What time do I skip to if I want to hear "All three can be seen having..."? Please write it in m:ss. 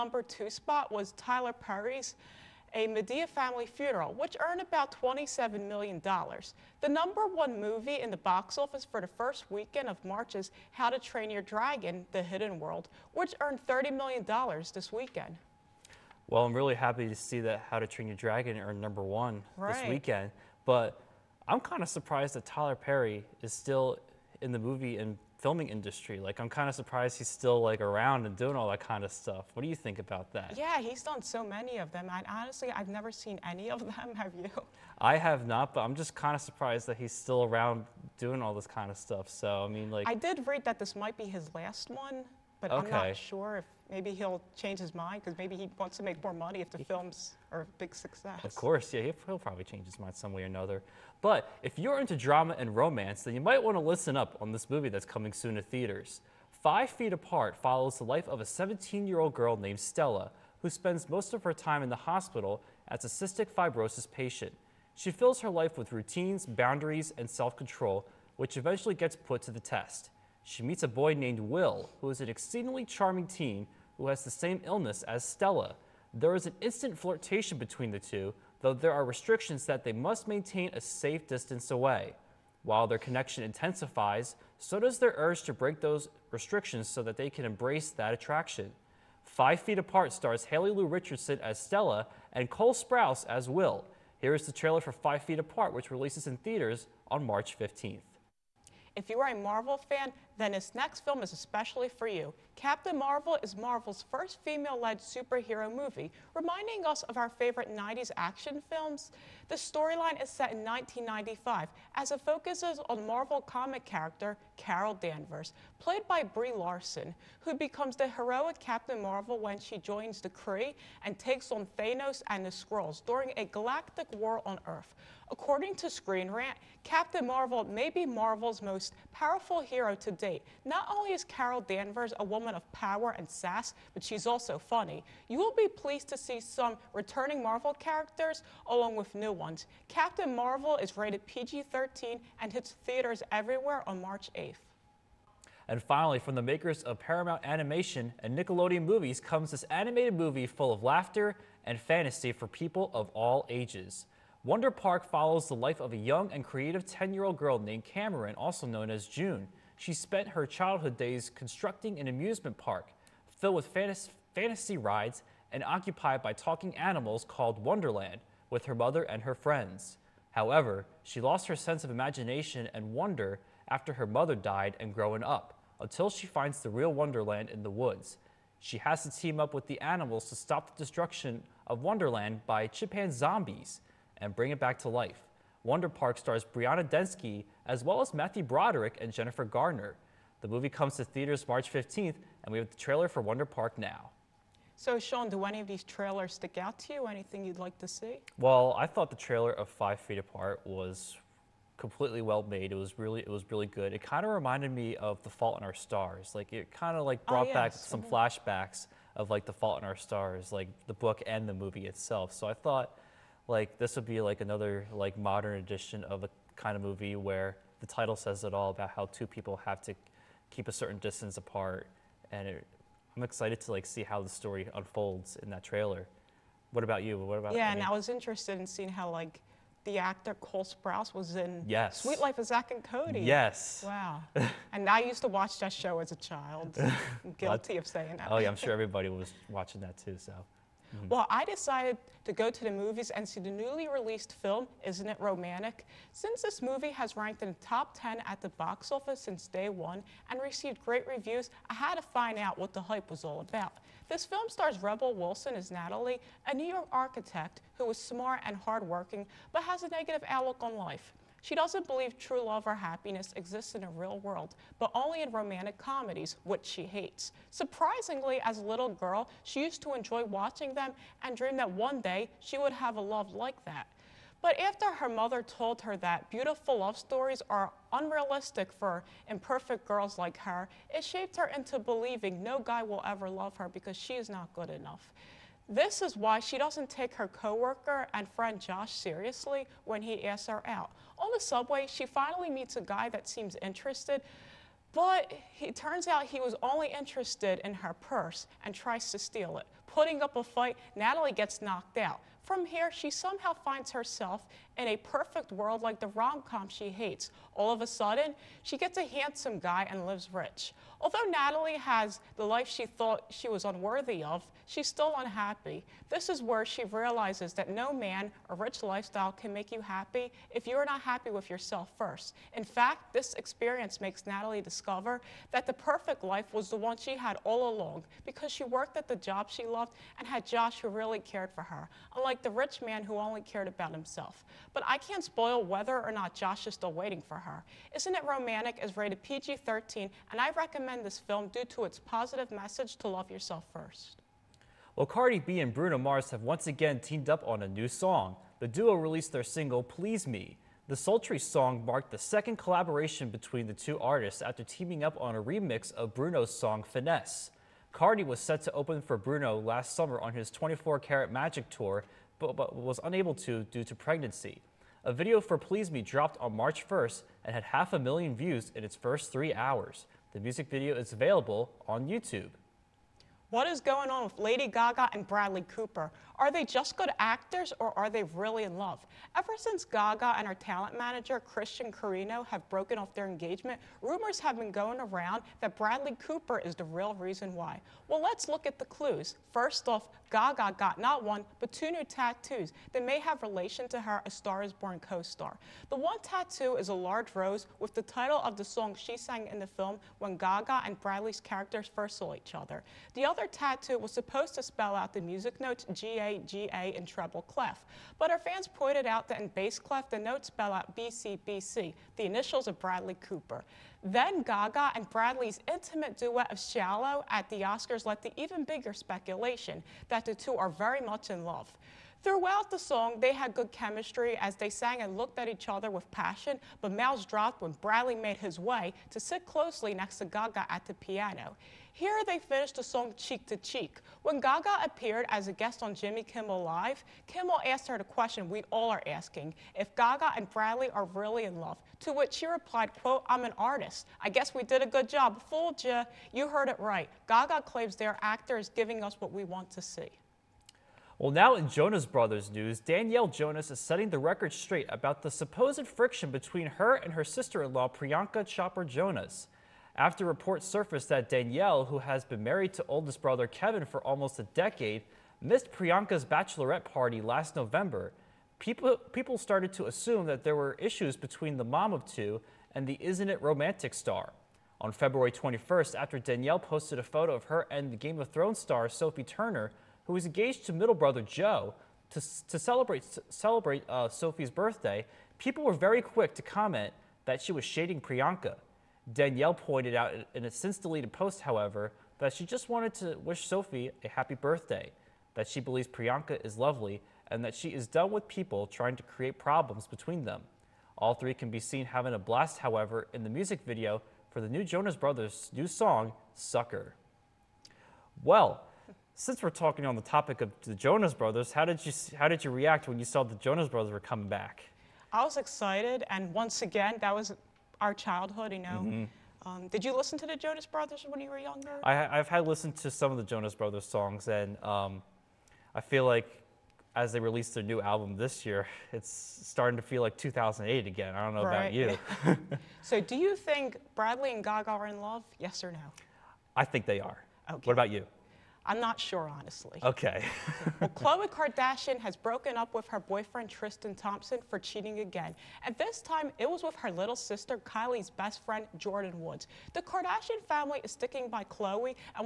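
8:20.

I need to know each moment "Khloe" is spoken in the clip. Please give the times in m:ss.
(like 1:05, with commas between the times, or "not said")
9:00, 9:11.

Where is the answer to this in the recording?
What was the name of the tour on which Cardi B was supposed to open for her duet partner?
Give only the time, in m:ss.
6:00.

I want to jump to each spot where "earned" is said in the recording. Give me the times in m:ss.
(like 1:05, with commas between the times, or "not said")
0:04, 0:13, 0:18.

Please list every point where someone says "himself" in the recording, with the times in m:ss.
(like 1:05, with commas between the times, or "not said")
5:33.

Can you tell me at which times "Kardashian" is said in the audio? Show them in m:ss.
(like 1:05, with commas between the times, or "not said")
9:01, 9:09.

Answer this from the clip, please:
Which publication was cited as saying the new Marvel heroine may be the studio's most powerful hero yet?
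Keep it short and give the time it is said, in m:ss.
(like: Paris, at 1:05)
Screen Rant, at 2:05.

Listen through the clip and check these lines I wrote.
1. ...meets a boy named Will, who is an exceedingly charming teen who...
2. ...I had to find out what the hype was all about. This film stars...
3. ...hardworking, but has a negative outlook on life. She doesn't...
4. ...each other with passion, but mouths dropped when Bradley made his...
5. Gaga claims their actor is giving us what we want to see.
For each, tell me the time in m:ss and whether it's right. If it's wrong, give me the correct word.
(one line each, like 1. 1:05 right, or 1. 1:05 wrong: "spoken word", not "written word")
1. 1:10 right
2. 4:11 right
3. 4:18 right
4. 7:05 right
5. 7:27 right.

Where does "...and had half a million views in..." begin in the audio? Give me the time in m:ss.
6:07.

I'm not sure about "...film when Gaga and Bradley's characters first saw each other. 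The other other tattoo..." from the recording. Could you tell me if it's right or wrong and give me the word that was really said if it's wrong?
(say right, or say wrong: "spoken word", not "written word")
right.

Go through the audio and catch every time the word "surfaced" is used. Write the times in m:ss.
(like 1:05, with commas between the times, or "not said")
7:40.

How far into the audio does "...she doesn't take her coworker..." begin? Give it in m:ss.
4:46.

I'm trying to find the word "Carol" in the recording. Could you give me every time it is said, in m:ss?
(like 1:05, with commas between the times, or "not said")
1:54, 2:11.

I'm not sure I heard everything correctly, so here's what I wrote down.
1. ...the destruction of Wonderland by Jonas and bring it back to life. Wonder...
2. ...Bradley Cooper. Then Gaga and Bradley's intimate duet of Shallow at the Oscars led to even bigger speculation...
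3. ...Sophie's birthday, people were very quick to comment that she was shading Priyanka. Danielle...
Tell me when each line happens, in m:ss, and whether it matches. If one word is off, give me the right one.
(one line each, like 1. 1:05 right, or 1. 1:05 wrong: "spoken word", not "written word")
1. 3:00 wrong: "Chimpanzombies", not "Jonas"
2. 6:52 right
3. 8:04 right.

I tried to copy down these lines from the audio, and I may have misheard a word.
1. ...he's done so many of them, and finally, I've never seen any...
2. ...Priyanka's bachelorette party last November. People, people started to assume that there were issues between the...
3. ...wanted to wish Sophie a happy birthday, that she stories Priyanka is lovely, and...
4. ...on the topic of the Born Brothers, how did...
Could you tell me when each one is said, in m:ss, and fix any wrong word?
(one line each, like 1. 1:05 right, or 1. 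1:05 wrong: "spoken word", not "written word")
1. 0:30 wrong: "honestly", not "finally"
2. 7:45 right
3. 8:12 wrong: "believes", not "stories"
4. 8:29 wrong: "Jonas", not "Born".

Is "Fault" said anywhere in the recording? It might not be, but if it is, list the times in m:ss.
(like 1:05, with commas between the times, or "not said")
3:25, 3:29.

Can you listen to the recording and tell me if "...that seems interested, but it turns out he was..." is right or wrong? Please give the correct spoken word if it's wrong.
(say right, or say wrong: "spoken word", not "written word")
right.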